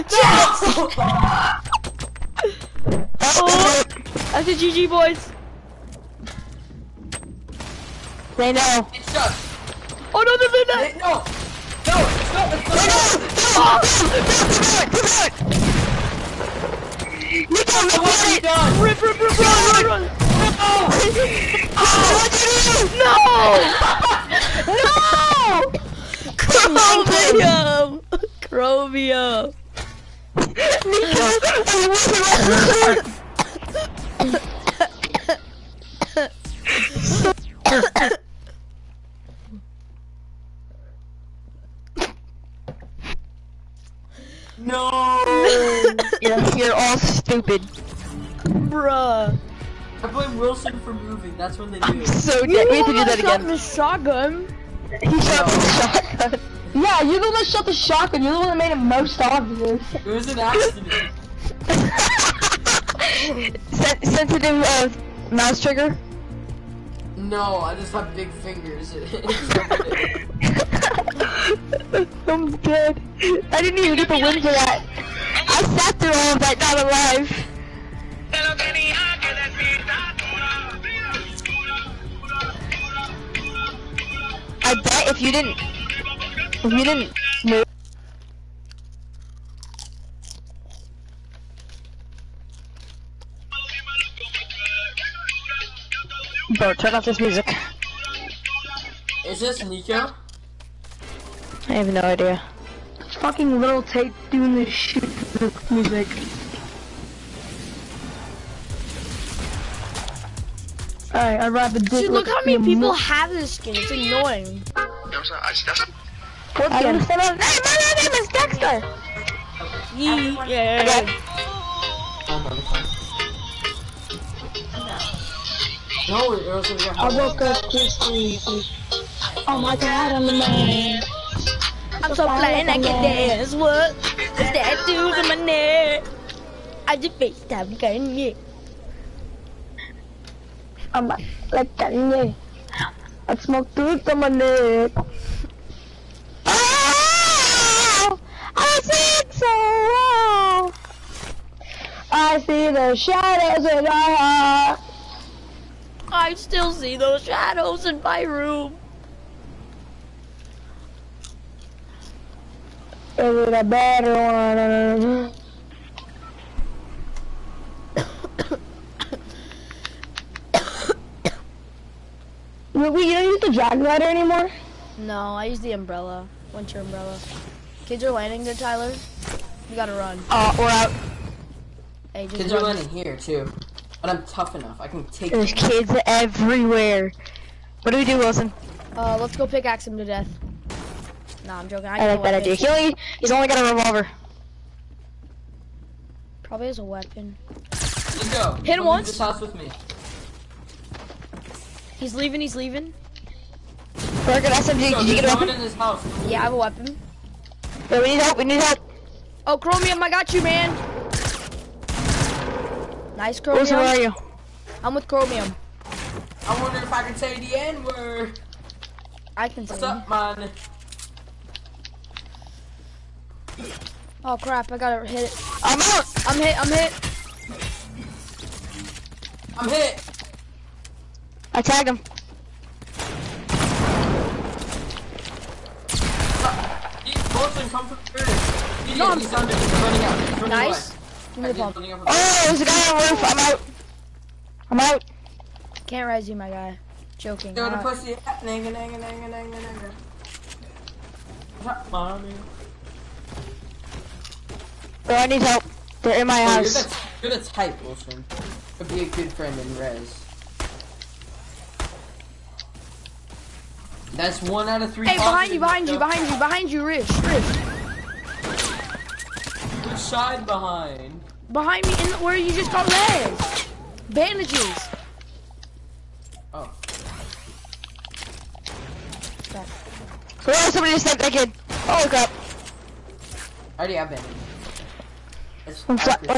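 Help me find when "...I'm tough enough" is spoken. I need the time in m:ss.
3:04.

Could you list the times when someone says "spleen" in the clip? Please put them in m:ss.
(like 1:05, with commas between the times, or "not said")
not said.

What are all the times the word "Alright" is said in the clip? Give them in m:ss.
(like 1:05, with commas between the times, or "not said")
1:51.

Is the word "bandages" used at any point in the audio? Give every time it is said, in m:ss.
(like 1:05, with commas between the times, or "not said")
4:34, 4:44.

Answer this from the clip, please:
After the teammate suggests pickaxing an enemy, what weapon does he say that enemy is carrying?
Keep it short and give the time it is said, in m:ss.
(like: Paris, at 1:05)
revolver, at 3:13.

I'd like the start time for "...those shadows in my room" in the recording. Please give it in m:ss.
2:36.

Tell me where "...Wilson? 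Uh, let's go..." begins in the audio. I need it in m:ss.
3:08.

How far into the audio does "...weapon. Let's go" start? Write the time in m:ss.
3:16.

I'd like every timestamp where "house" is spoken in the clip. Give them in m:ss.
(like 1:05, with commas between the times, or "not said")
3:19, 3:25, 4:16.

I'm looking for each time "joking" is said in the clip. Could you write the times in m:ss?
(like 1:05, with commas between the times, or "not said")
3:11, 4:07.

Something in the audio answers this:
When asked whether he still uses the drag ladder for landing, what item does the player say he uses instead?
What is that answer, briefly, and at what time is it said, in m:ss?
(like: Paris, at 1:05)
Winter umbrella, at 2:56.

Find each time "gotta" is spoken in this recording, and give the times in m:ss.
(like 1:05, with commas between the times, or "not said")
2:59, 3:44.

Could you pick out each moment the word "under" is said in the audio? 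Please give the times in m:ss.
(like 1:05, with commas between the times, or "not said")
3:59.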